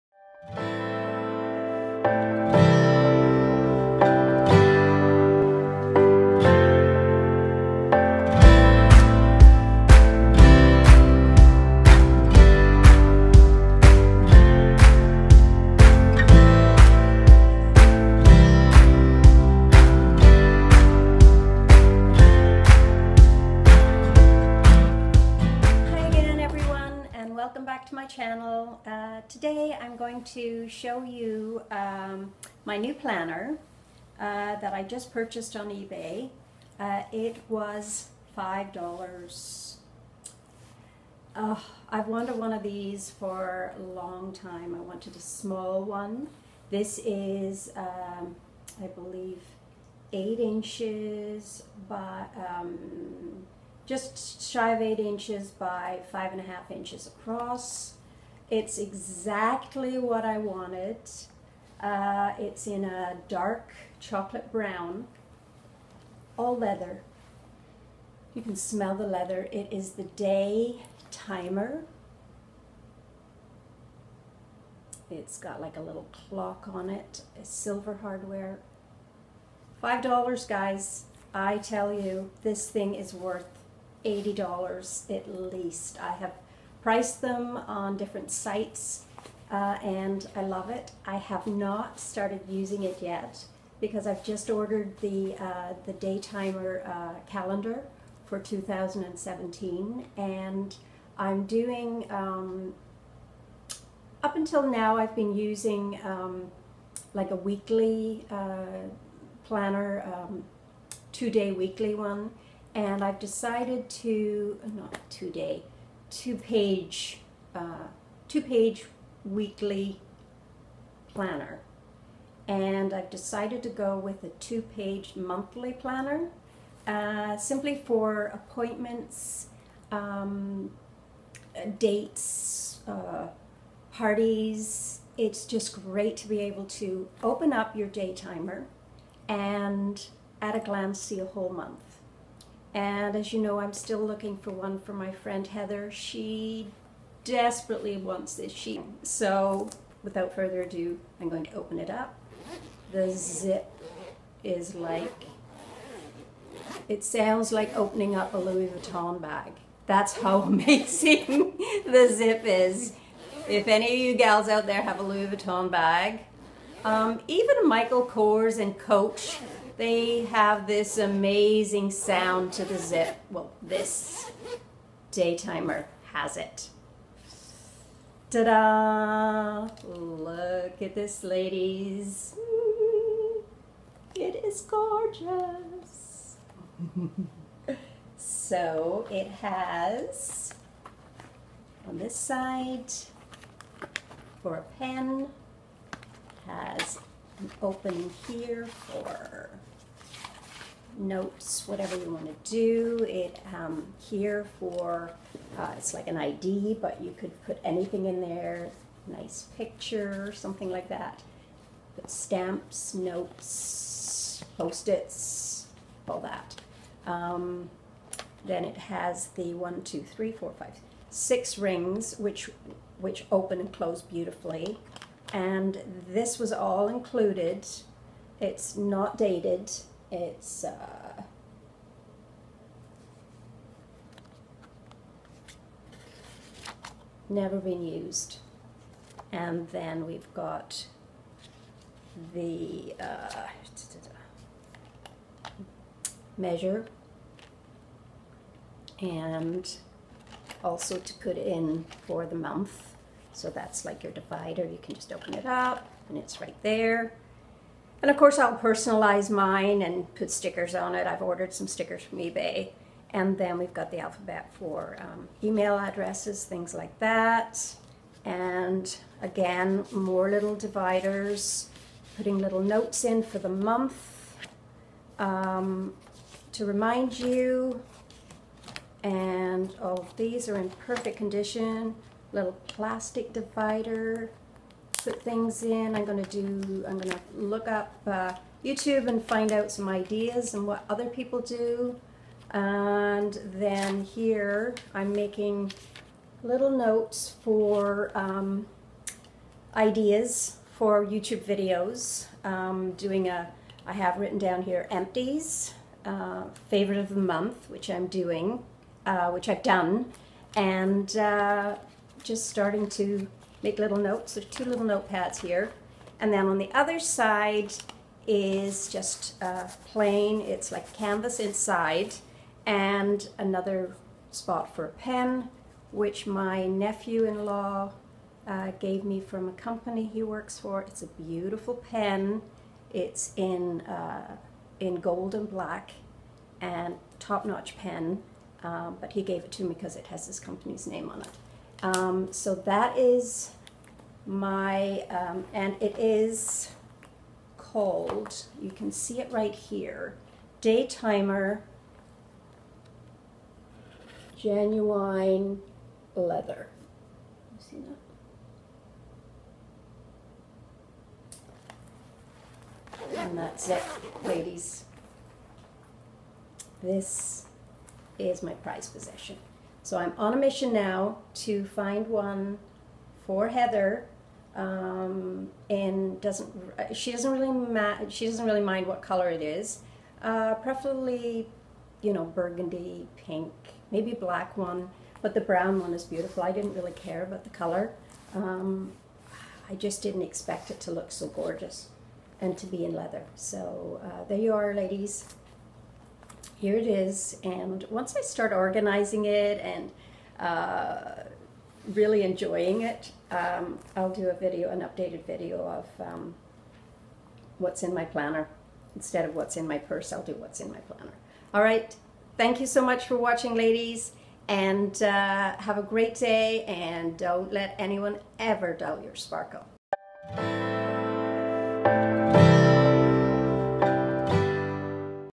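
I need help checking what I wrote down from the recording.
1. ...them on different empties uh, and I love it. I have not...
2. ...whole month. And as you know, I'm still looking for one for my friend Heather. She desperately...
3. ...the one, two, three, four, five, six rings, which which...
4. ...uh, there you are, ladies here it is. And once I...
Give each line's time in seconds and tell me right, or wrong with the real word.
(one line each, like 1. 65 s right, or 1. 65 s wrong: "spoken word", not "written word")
1. 87 s wrong: "sites", not "empties"
2. 141 s right
3. 219 s right
4. 394 s right.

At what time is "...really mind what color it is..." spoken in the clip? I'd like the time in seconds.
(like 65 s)
378 s.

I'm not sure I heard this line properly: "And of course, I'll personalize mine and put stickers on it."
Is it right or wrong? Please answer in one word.
right.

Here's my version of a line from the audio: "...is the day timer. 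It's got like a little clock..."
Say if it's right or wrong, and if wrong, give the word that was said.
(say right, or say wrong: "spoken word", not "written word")
right.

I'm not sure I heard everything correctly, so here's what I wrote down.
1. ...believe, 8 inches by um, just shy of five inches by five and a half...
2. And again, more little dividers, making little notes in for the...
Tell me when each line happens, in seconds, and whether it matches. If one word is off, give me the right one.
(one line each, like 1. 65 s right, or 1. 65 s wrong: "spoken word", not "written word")
1. 48 s wrong: "eight", not "five"
2. 268 s wrong: "putting", not "making".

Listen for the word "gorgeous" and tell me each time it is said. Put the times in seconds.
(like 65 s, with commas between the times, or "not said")
184 s, 391 s.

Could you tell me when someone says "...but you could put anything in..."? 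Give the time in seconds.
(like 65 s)
206 s.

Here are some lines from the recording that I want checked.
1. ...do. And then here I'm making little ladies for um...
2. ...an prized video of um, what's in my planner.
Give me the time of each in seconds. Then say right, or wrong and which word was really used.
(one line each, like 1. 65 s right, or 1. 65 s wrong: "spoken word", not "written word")
1. 291 s wrong: "notes", not "ladies"
2. 404 s wrong: "updated", not "prized".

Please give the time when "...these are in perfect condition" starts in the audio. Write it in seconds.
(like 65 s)
280 s.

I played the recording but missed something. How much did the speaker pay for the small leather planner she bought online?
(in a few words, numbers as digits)
$5.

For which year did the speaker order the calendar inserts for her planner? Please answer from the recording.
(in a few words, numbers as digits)
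2017.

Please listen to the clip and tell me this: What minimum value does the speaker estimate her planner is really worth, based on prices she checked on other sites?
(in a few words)
$80.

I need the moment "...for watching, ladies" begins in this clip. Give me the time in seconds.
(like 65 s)
413 s.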